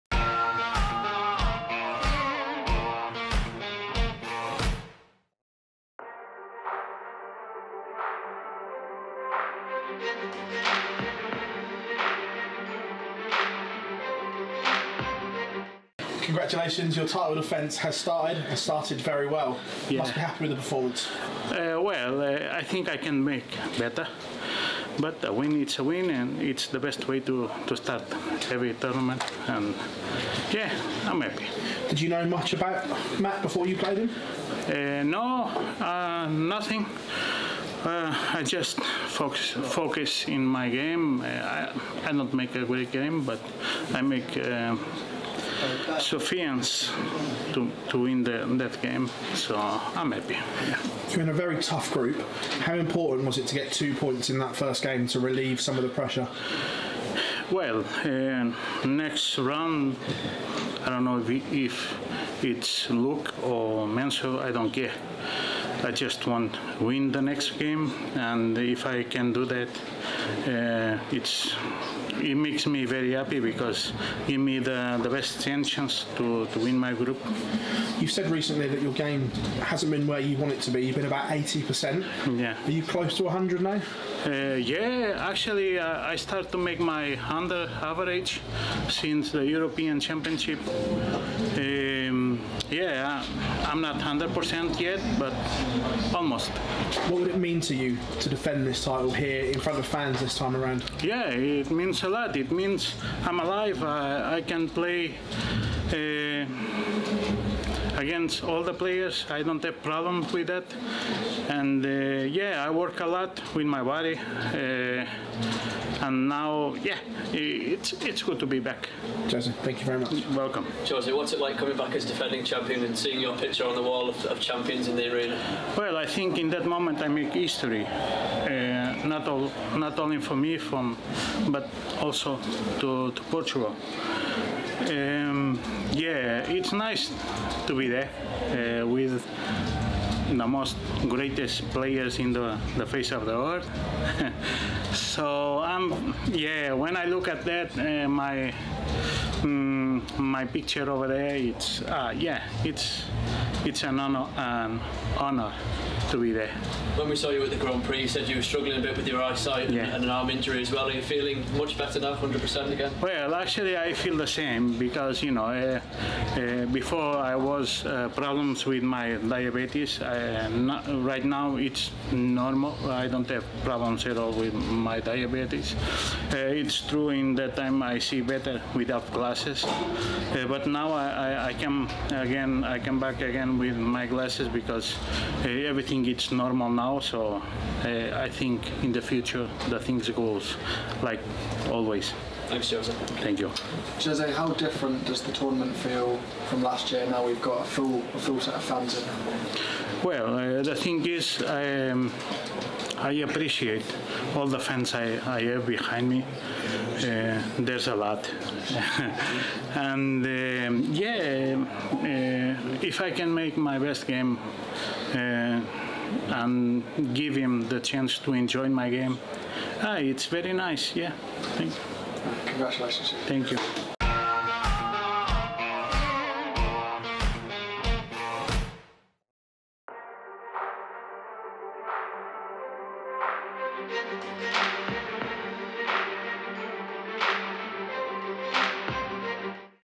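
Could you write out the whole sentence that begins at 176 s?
Uh, it's true in that time I see better without glasses.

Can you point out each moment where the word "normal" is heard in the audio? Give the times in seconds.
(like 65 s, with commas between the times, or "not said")
172 s, 186 s.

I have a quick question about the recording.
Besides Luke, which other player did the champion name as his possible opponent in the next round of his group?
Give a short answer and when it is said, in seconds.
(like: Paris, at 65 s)
Mensur, at 63 s.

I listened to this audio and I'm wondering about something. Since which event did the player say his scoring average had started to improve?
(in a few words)
European Championship.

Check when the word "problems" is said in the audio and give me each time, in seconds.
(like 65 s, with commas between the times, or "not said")
109 s, 168 s, 173 s.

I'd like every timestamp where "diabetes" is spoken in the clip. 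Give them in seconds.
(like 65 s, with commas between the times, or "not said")
169 s, 174 s.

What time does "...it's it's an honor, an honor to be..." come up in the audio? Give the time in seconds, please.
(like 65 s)
152 s.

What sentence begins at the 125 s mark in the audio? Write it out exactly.
Well, I think in that moment I make history.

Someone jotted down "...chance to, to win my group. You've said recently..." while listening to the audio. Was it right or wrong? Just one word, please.
right.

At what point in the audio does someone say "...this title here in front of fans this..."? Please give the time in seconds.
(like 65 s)
98 s.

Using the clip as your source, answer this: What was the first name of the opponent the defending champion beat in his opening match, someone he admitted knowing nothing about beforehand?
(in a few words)
Matt.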